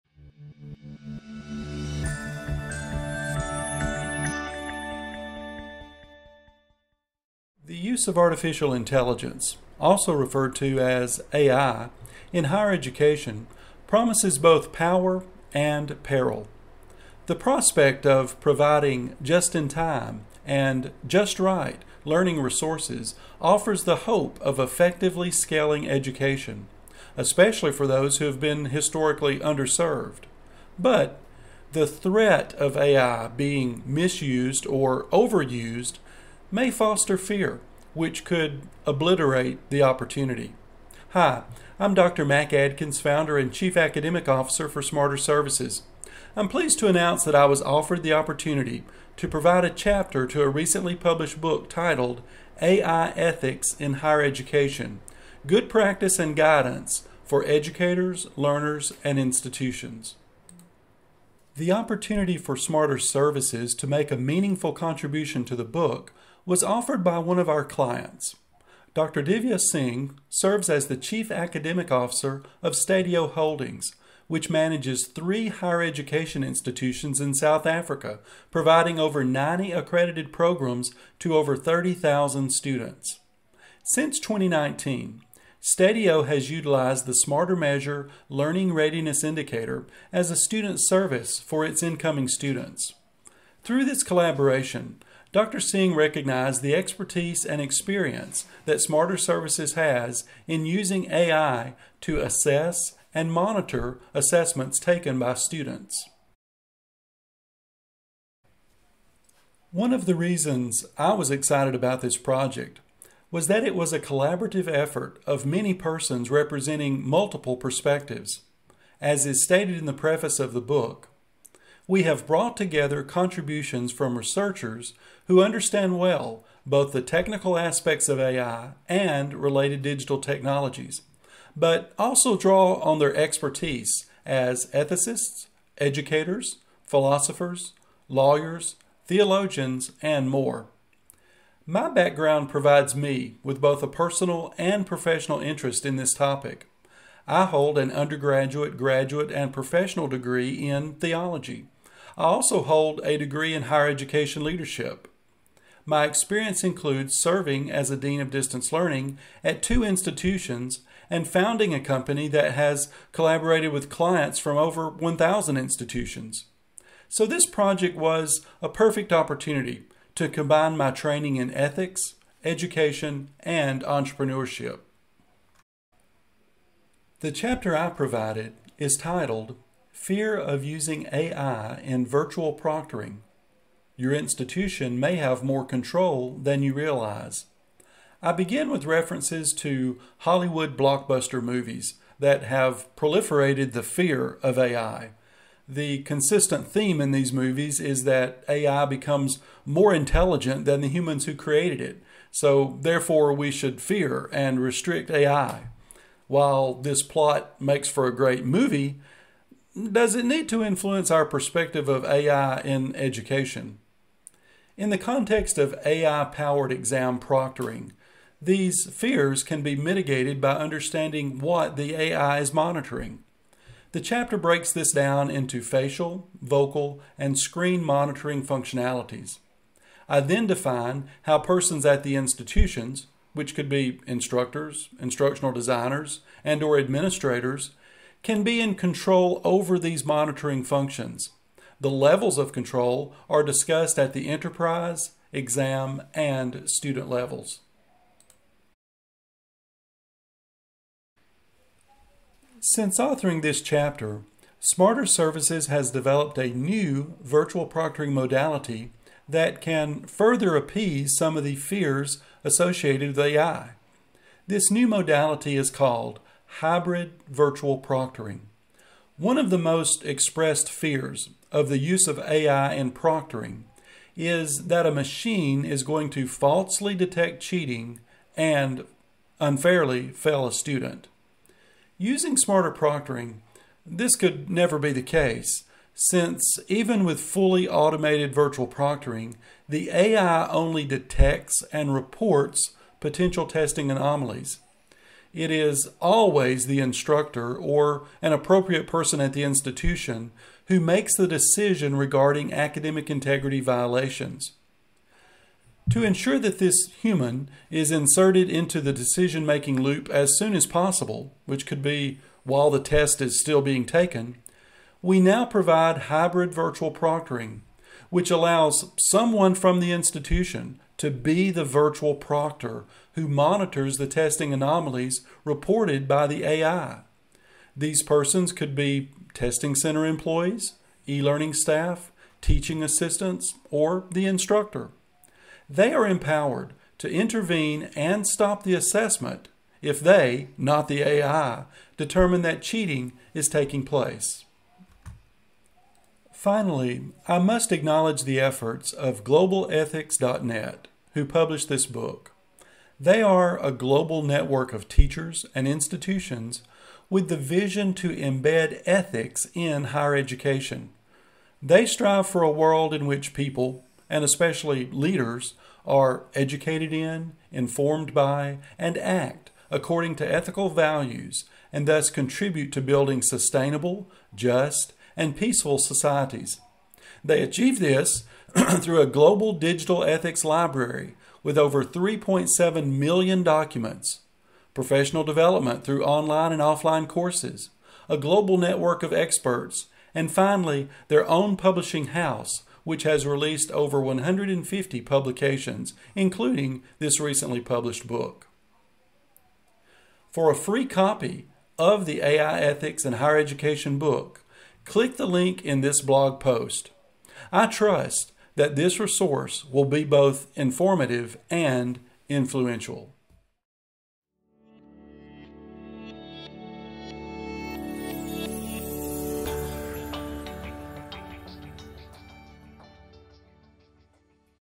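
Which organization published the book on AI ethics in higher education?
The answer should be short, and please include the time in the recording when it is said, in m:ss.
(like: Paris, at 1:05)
Globethics.net, at 5:49.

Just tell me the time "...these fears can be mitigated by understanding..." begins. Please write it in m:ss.
3:38.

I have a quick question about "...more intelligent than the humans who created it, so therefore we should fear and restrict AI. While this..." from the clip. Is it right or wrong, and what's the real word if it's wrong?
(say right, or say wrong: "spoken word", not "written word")
right.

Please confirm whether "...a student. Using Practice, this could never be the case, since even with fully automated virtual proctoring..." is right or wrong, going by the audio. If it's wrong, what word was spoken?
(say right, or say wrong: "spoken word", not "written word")
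wrong: "SmarterProctoring", not "Practice".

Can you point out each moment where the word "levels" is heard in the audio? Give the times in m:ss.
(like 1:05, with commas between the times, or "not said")
4:01, 4:07.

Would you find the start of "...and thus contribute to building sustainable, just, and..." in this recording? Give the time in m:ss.
6:11.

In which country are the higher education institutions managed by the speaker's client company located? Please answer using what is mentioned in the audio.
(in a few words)
South Africa.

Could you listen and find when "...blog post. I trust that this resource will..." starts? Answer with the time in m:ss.
6:46.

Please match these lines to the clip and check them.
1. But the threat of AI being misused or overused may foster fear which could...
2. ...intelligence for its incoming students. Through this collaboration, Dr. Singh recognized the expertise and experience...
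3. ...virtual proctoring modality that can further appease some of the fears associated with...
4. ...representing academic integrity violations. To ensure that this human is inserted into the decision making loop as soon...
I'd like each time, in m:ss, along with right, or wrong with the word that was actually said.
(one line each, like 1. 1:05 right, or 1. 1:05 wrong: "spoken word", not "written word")
1. 0:30 right
2. 1:30 wrong: "service", not "intelligence"
3. 4:17 right
4. 5:01 wrong: "regarding", not "representing".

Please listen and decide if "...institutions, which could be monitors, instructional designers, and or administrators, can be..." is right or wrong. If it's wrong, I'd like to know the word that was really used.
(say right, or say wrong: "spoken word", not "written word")
wrong: "instructors", not "monitors".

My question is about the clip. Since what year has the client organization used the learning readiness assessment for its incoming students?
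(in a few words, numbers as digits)
2019.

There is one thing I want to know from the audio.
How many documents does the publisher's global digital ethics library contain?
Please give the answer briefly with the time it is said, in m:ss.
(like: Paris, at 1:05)
Over 3.7 million, at 6:21.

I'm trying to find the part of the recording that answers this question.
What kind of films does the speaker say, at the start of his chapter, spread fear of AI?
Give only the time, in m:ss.
3:10.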